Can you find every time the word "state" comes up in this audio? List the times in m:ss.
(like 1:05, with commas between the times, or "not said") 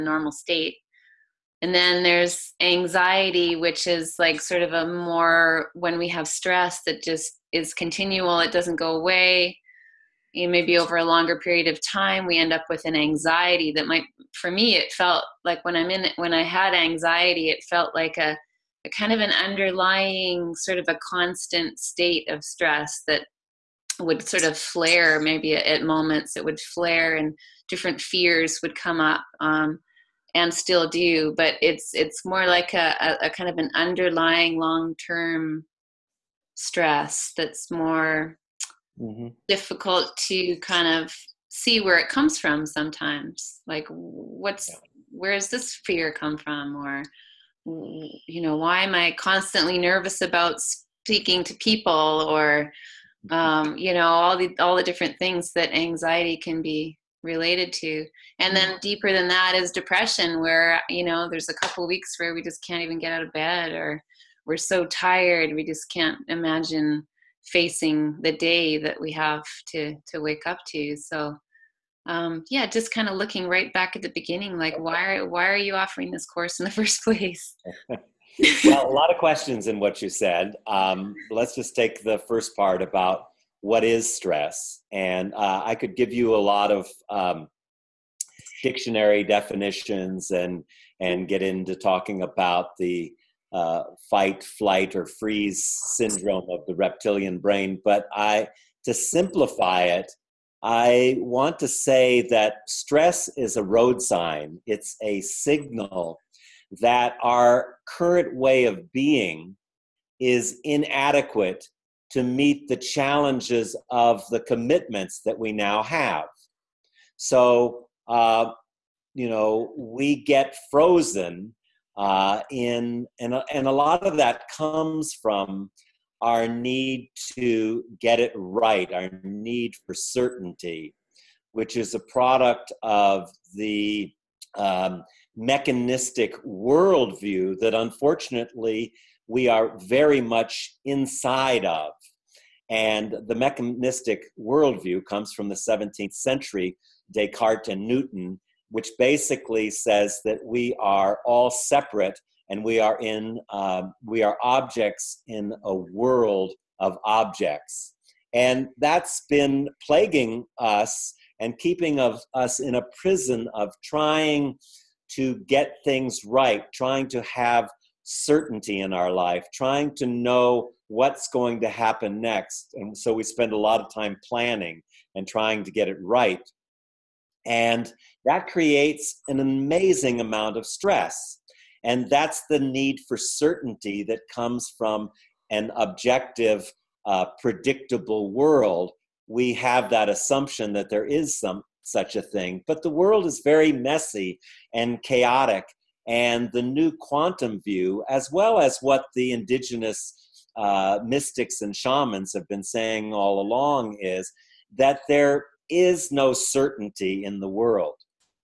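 0:00, 0:21.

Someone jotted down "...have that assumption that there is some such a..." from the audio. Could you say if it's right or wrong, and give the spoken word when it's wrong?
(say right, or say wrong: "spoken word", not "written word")
right.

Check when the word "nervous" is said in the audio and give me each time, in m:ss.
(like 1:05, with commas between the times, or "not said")
0:49.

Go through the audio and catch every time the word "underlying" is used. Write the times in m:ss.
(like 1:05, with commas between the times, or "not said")
0:19, 0:33.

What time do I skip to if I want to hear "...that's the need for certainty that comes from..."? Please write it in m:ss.
3:02.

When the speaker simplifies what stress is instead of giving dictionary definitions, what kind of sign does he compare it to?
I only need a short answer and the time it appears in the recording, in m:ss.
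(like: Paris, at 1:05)
A road sign, at 1:43.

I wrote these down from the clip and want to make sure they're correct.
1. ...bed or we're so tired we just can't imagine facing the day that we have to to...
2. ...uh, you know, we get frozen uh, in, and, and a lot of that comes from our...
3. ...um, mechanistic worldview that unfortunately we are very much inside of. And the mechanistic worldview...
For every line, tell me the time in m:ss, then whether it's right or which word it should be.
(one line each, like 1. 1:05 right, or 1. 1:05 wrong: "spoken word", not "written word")
1. 1:03 right
2. 1:58 right
3. 2:14 right.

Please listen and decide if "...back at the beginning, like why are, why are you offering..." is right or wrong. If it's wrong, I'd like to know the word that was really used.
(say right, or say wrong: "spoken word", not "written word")
right.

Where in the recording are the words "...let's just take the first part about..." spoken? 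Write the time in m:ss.
1:21.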